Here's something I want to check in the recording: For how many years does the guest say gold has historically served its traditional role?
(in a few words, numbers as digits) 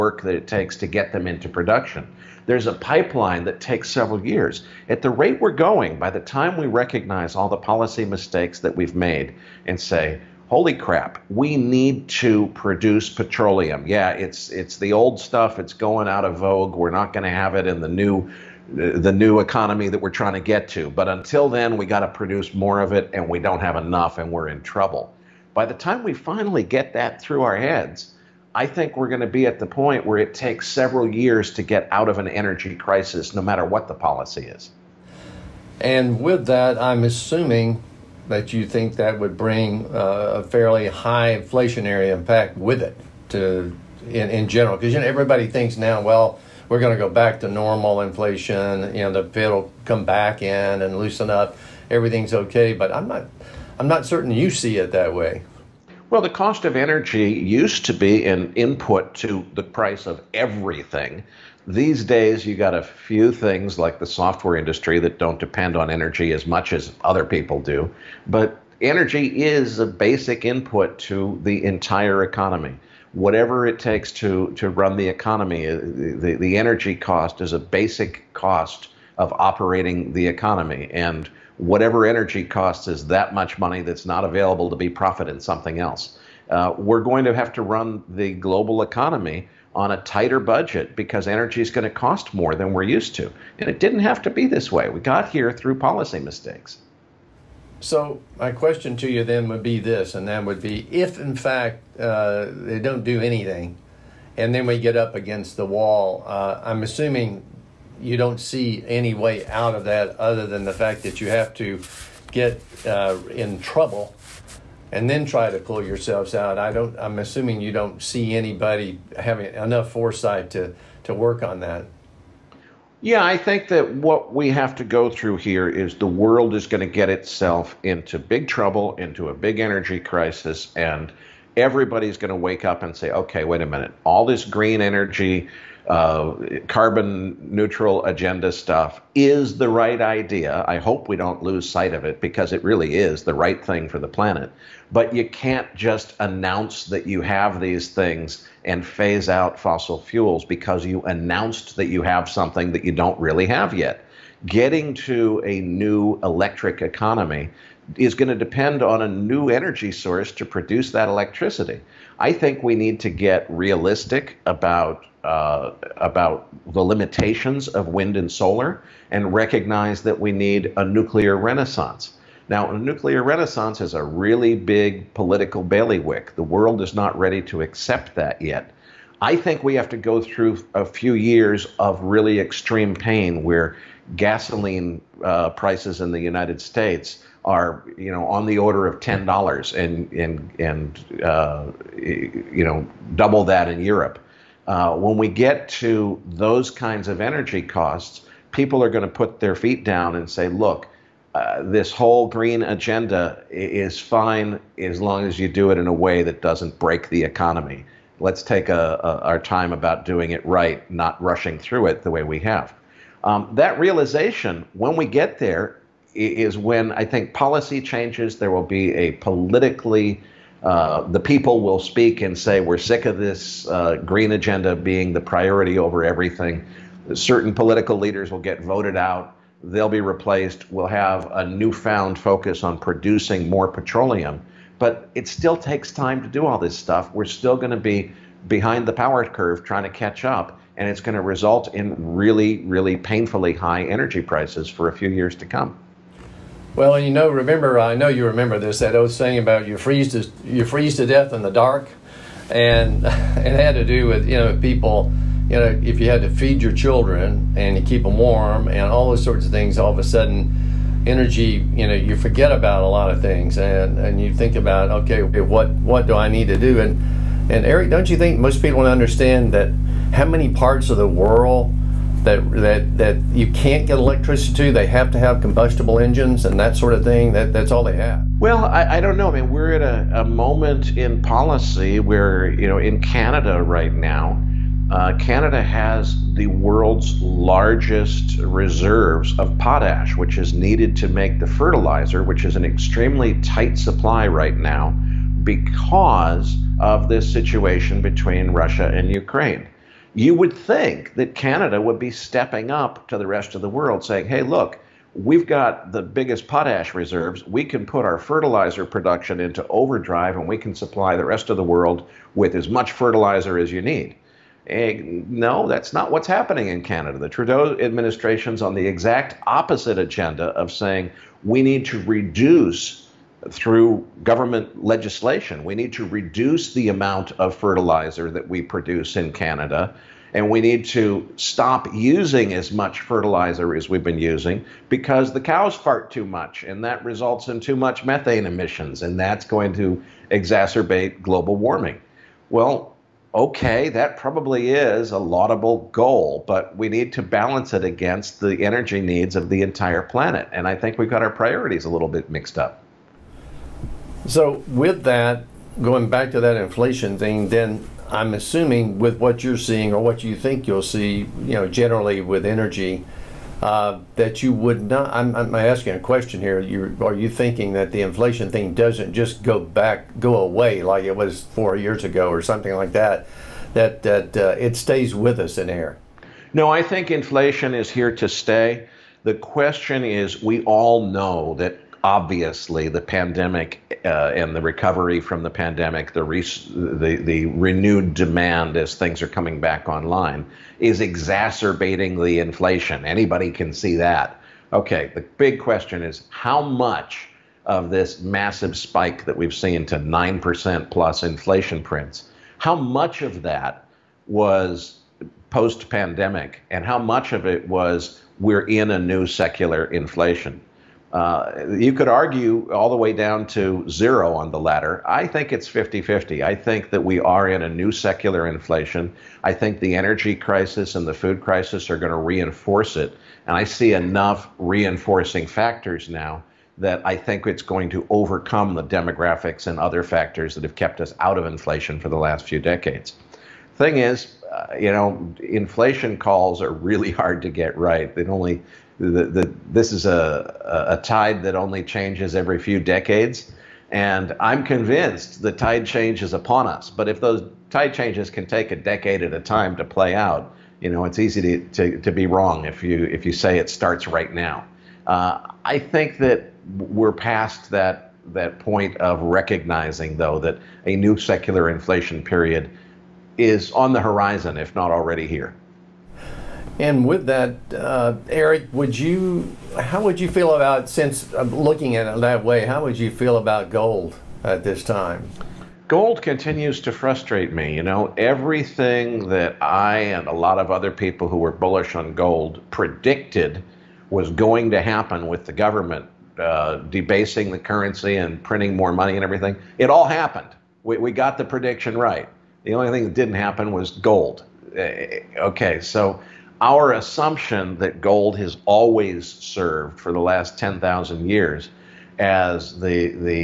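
10,000 years.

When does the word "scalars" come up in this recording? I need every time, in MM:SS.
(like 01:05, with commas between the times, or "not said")
not said.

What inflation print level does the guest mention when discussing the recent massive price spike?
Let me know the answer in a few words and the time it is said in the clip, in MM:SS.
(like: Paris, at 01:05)
9% plus, at 06:39.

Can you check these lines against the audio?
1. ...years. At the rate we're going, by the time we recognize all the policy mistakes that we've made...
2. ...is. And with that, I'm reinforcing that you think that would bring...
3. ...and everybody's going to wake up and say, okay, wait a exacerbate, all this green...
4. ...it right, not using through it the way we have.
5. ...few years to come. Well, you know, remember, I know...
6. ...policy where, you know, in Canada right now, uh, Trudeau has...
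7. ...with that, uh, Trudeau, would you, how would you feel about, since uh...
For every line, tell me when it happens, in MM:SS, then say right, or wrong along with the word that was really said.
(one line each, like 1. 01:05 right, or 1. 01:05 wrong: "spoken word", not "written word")
1. 00:04 right
2. 00:34 wrong: "assuming", not "reinforcing"
3. 02:10 wrong: "minute", not "exacerbate"
4. 03:30 wrong: "rushing", not "using"
5. 04:04 right
6. 04:41 wrong: "Canada", not "Trudeau"
7. 07:47 wrong: "Erik", not "Trudeau".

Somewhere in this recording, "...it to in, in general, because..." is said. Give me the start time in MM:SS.
00:42.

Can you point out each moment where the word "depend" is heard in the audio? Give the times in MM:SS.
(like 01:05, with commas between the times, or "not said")
01:05, 02:38.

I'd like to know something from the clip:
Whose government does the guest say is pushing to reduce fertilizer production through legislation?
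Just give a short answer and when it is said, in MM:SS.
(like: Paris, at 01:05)
Trudeau administration, at 05:17.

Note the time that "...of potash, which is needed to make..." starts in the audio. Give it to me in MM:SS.
04:49.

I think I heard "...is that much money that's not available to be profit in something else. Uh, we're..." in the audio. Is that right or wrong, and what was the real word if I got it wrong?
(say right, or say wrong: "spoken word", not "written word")
right.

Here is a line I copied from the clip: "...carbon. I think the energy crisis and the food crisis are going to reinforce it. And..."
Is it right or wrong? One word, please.
wrong.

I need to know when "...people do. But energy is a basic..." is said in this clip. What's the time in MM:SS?
01:07.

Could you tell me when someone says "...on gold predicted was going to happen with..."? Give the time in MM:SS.
08:01.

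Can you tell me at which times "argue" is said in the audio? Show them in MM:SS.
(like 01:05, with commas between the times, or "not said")
06:52.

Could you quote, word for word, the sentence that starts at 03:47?
Certain political leaders will get voted out.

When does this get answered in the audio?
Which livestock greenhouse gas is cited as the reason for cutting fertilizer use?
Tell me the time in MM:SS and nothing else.
05:38.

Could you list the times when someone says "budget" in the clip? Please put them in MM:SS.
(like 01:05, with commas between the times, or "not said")
01:30.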